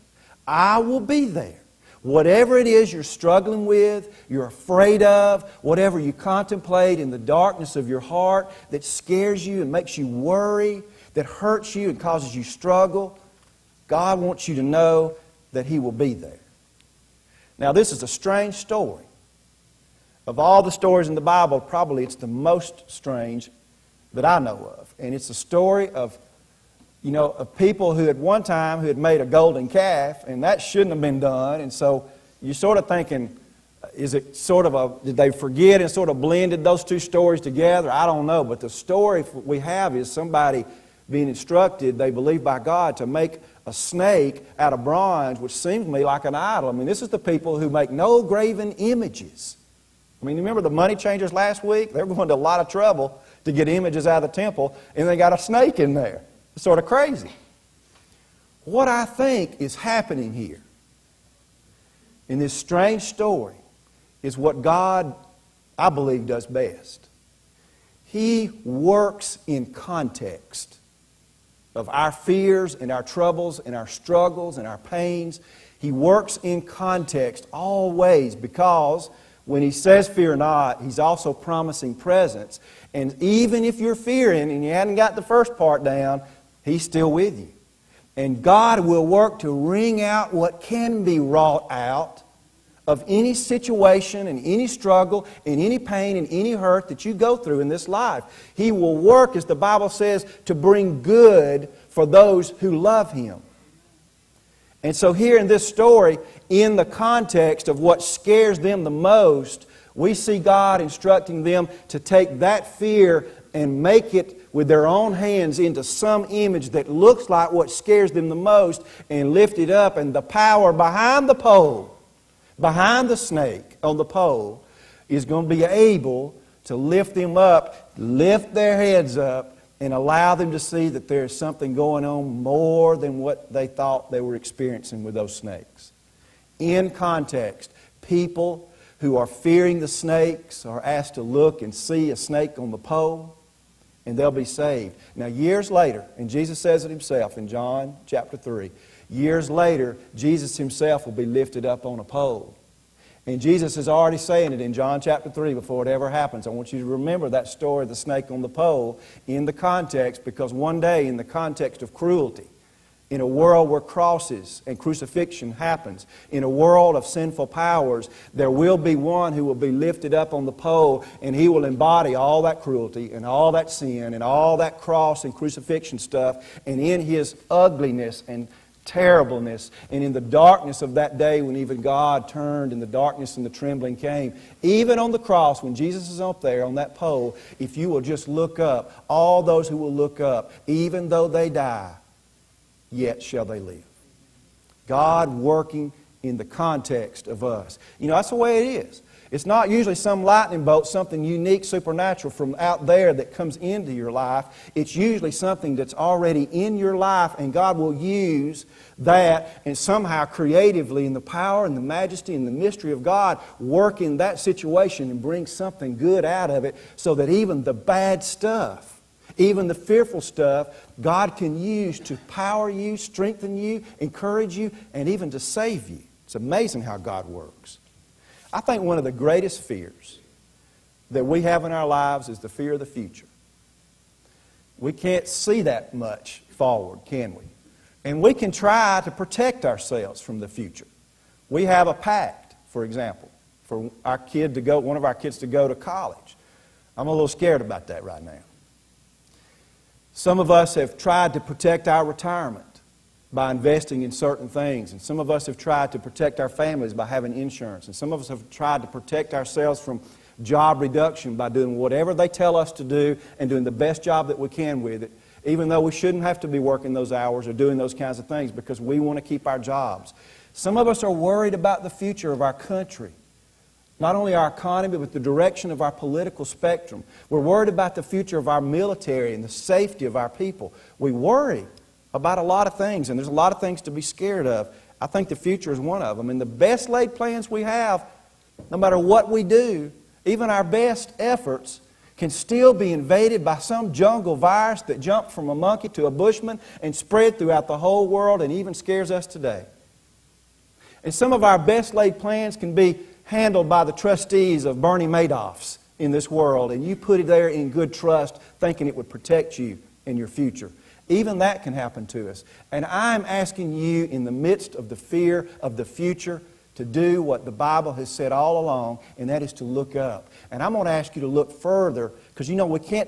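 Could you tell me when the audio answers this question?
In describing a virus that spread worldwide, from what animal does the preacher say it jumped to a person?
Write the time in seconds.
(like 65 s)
295 s.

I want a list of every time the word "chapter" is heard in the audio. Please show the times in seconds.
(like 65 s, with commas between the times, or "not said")
148 s, 155 s.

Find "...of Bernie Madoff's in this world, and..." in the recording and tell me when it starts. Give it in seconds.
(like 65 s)
304 s.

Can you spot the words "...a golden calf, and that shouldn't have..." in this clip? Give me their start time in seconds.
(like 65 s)
29 s.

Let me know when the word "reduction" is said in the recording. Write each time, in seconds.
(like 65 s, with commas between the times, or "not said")
260 s.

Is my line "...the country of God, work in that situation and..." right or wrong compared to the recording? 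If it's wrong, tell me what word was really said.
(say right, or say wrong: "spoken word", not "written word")
wrong: "mystery", not "country".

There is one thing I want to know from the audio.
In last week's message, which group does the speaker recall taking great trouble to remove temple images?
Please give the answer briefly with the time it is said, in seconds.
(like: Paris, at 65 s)
money changers, at 50 s.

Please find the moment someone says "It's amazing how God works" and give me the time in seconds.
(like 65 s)
226 s.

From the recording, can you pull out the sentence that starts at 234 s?
We can't see that much forward, can we?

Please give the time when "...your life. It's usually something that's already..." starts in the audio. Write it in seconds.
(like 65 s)
203 s.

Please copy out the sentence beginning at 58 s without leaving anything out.
What I think is happening here in this strange story is what God, I believe, does best.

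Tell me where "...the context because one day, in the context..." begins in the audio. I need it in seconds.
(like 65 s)
159 s.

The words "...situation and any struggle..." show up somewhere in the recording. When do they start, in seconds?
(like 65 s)
93 s.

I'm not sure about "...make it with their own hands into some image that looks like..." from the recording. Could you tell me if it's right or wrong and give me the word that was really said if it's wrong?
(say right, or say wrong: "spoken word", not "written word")
right.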